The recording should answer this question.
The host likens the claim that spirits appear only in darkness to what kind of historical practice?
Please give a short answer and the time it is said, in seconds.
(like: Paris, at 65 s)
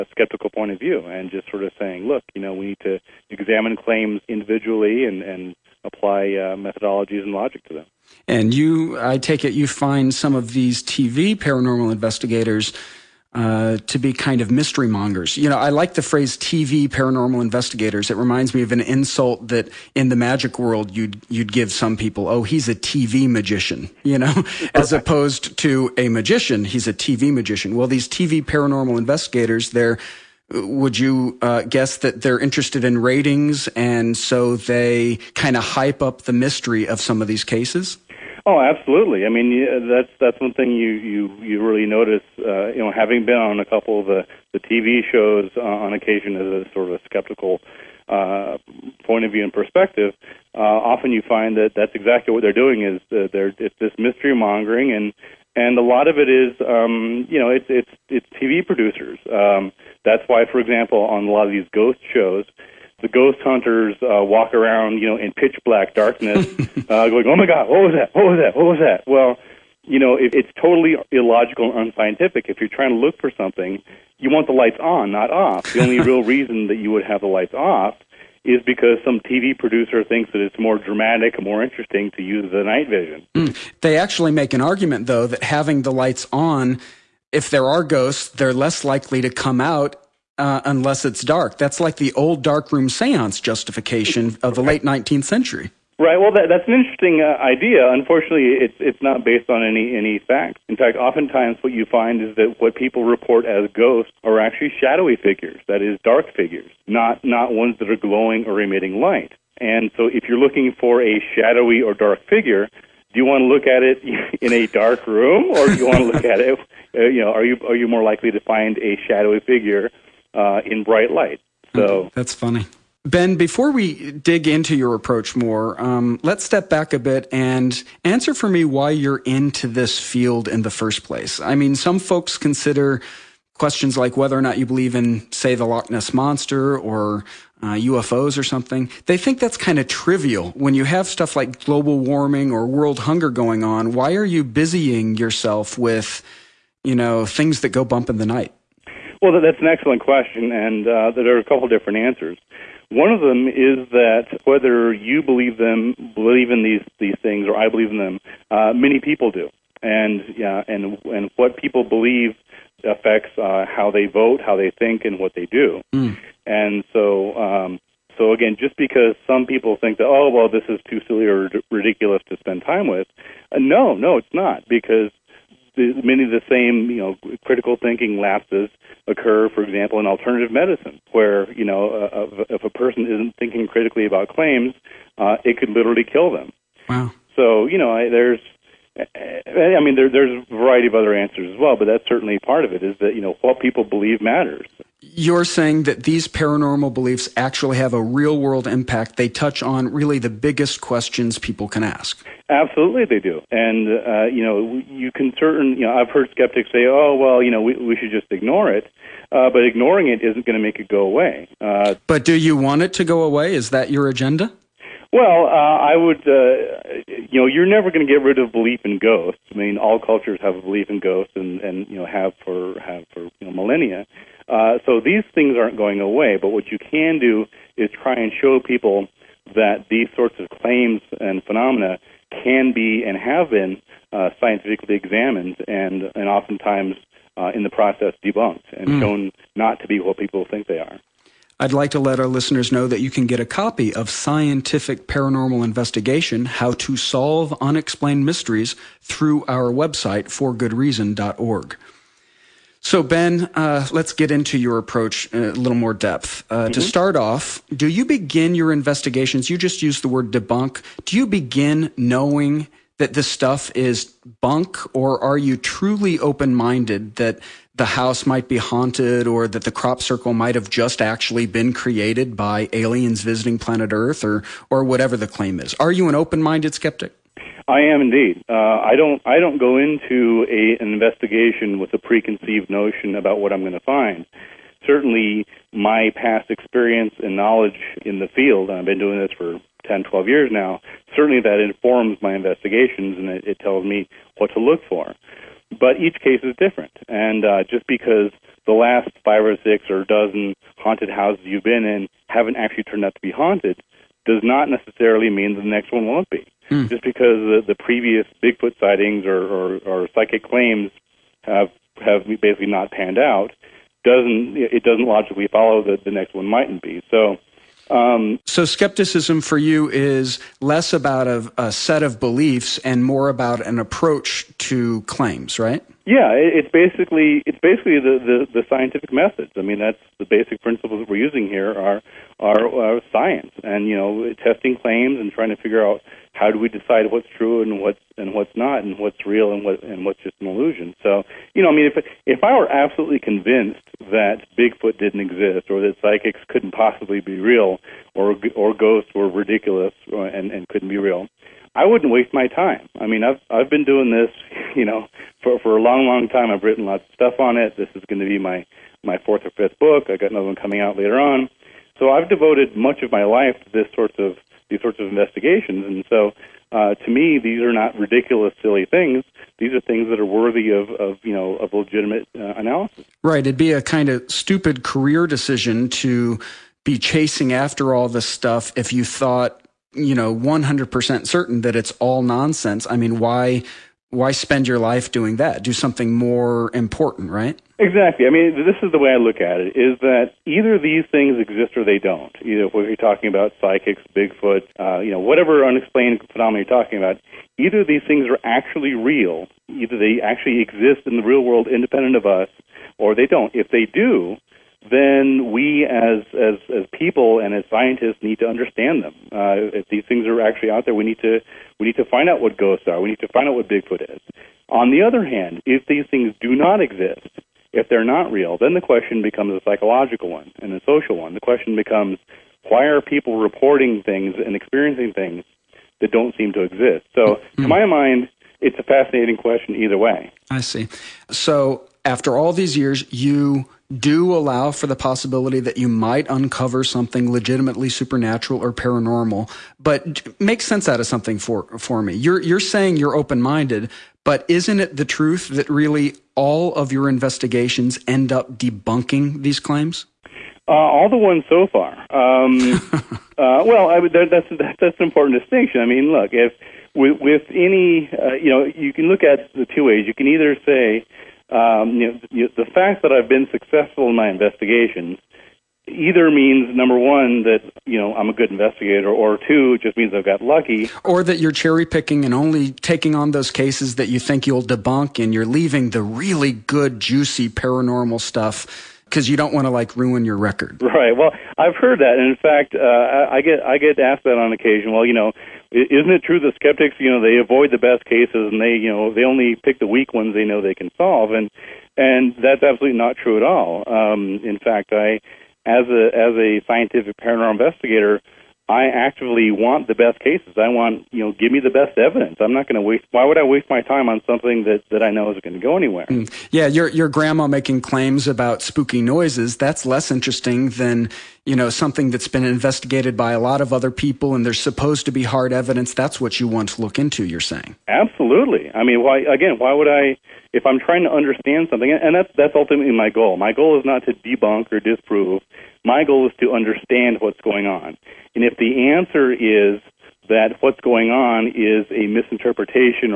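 darkroom seance, at 92 s.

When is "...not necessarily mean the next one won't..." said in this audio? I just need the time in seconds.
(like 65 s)
304 s.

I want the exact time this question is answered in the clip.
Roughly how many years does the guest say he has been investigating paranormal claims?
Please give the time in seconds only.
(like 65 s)
289 s.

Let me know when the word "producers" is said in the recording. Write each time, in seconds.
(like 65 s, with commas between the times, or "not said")
58 s, 79 s.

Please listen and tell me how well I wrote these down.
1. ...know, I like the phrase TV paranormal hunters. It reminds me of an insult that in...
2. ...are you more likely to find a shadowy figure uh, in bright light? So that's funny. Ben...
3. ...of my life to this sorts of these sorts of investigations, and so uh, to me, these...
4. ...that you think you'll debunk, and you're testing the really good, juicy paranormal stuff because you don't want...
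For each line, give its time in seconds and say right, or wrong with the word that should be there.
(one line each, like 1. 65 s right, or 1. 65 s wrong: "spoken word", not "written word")
1. 15 s wrong: "investigators", not "hunters"
2. 117 s right
3. 363 s right
4. 473 s wrong: "leaving", not "testing".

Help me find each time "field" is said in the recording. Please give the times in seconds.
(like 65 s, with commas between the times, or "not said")
129 s, 288 s.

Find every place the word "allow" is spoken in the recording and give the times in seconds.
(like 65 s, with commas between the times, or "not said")
434 s.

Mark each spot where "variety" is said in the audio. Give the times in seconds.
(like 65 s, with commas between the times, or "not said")
190 s.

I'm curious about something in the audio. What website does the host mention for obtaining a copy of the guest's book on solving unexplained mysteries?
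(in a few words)
forgoodreason.org.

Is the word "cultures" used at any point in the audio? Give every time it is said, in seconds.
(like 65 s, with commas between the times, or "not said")
219 s.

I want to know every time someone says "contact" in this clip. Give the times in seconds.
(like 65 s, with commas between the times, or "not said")
not said.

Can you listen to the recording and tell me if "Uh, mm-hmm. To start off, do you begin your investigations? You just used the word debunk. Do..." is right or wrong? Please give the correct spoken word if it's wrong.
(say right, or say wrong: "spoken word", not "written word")
right.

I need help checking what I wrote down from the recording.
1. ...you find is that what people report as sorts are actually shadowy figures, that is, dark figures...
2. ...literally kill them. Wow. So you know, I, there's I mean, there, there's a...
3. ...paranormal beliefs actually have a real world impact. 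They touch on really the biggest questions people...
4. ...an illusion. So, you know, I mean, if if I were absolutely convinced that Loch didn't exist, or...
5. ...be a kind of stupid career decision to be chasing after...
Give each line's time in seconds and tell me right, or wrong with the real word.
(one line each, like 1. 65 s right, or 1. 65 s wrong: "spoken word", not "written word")
1. 101 s wrong: "ghosts", not "sorts"
2. 185 s right
3. 196 s right
4. 340 s wrong: "Bigfoot", not "Loch"
5. 373 s right.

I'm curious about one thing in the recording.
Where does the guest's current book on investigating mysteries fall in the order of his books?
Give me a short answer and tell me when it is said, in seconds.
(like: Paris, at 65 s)
fourth or fifth, at 359 s.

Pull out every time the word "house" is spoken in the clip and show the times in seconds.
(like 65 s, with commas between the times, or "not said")
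267 s, 301 s.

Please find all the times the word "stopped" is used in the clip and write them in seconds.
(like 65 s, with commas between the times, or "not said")
not said.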